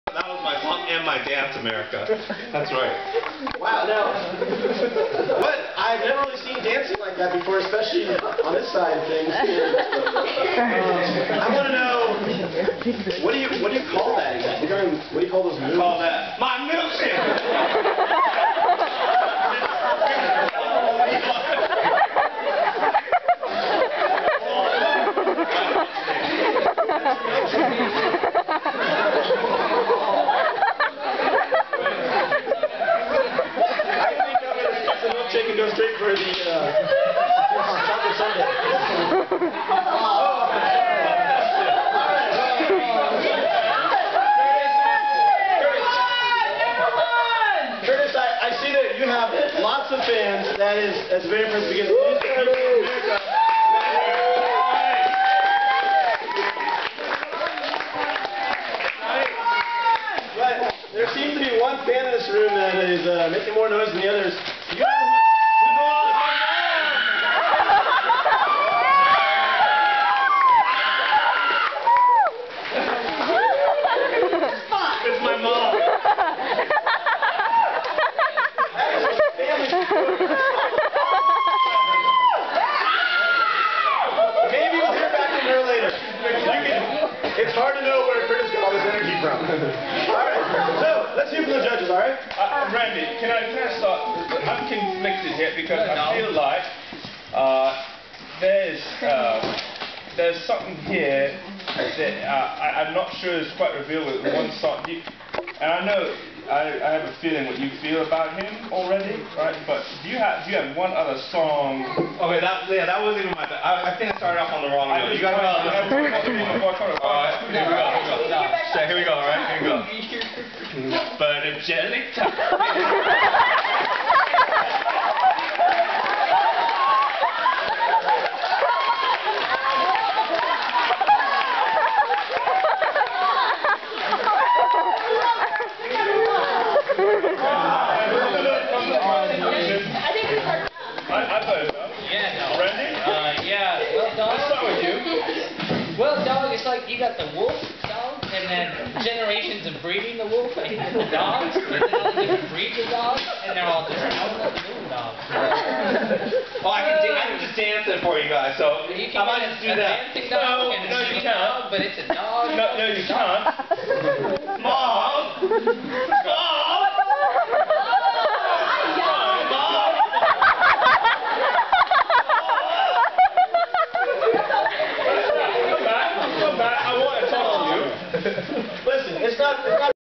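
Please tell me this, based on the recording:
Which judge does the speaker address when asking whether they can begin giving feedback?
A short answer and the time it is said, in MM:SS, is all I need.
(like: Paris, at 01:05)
Randy, at 01:32.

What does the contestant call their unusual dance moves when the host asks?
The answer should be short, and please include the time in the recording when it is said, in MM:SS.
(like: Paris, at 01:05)
My milkshake, at 00:16.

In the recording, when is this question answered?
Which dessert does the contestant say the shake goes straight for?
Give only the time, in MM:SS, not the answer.
00:37.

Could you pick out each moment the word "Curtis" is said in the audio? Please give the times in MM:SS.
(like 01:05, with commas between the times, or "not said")
00:47, 01:28.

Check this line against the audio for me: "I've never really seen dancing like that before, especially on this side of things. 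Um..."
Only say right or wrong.
right.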